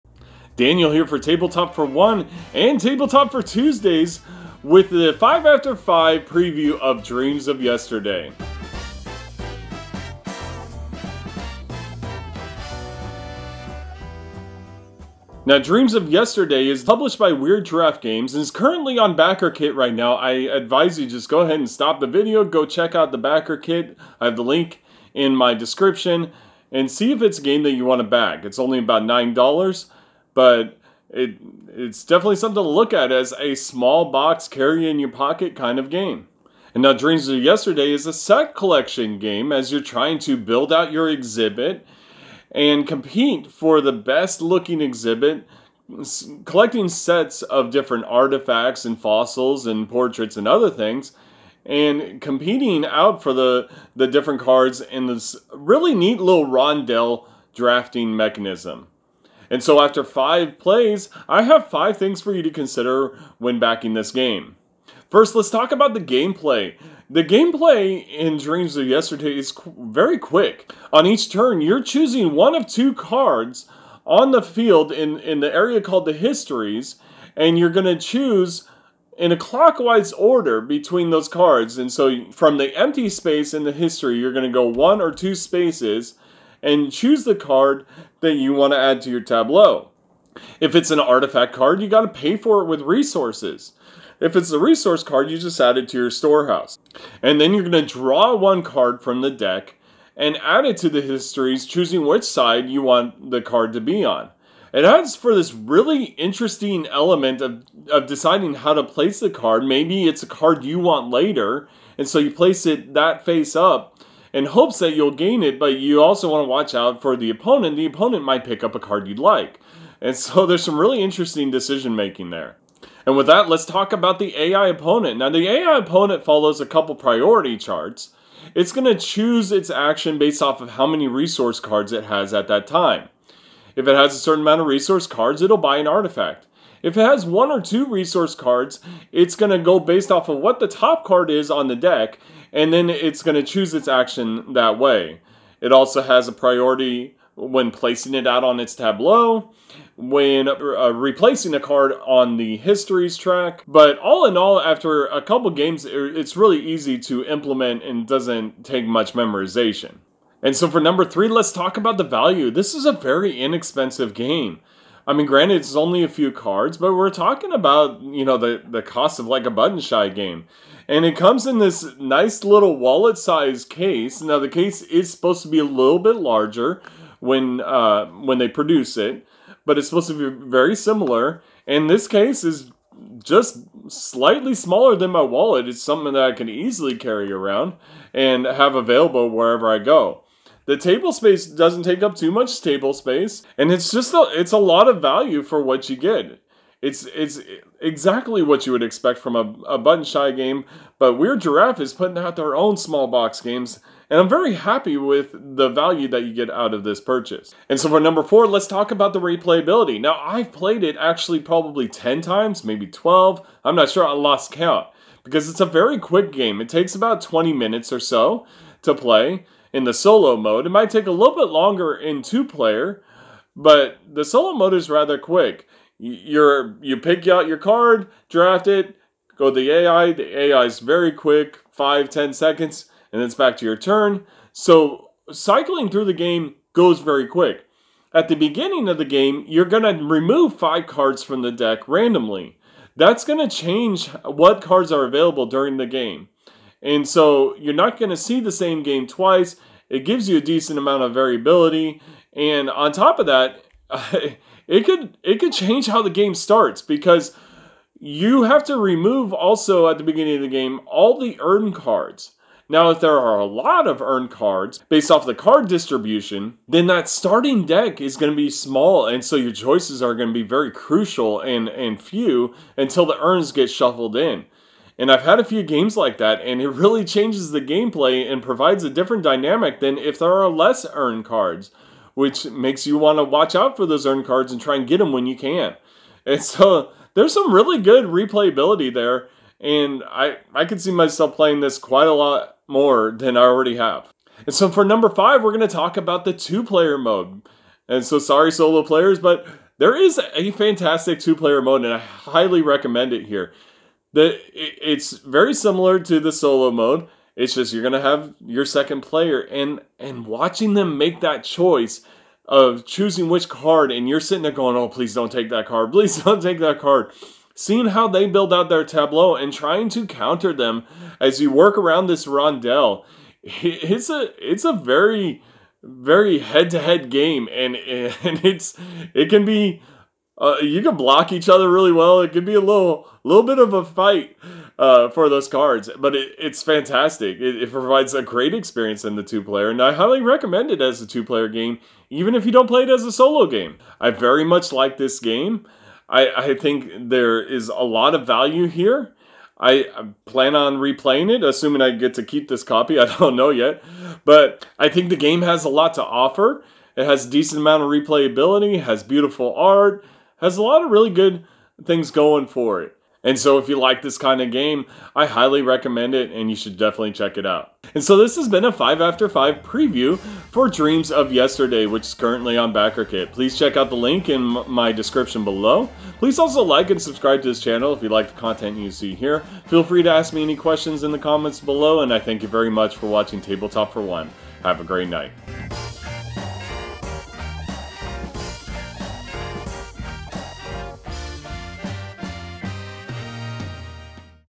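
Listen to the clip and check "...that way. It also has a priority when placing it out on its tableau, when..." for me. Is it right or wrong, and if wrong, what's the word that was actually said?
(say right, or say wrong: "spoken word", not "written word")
right.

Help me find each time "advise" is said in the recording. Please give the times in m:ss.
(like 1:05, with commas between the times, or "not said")
0:20.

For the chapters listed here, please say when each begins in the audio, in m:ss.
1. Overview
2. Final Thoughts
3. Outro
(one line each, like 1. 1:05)
1. 0:15
2. 5:43
3. 6:07.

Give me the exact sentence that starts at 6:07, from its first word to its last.
And so, this has been a 5 after 5 preview for Dreams of Yesterday, which is currently on BackerKit.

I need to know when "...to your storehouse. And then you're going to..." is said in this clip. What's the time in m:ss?
1:35.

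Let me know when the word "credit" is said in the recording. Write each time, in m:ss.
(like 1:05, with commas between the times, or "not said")
not said.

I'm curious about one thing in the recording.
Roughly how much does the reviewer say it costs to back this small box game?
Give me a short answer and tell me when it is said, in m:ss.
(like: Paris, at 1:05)
$9, at 0:29.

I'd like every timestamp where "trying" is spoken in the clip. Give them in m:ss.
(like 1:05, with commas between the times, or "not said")
0:39, 5:19.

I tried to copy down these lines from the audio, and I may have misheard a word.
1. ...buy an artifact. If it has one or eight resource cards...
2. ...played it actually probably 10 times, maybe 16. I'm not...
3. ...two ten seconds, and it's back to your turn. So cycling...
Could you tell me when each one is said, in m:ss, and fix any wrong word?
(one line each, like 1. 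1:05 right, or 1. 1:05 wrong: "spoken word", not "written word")
1. 2:15 wrong: "two", not "eight"
2. 3:30 wrong: "12", not "16"
3. 3:51 wrong: "five", not "two".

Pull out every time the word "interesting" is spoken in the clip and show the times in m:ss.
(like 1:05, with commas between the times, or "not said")
1:46, 2:01.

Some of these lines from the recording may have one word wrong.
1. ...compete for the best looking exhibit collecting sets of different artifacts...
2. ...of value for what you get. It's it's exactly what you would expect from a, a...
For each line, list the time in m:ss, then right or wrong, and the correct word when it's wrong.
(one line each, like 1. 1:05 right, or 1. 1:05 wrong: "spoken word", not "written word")
1. 0:42 right
2. 3:14 right.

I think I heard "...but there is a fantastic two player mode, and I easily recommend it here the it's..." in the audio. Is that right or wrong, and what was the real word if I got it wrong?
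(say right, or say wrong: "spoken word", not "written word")
wrong: "highly", not "easily".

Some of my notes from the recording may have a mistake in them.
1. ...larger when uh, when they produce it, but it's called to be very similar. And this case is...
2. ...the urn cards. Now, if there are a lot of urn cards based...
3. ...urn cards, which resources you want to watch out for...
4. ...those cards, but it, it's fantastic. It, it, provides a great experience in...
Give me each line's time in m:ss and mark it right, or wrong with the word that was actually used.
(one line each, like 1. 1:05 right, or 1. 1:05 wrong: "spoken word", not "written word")
1. 2:56 wrong: "supposed", not "called"
2. 4:21 right
3. 4:40 wrong: "makes", not "resources"
4. 5:35 right.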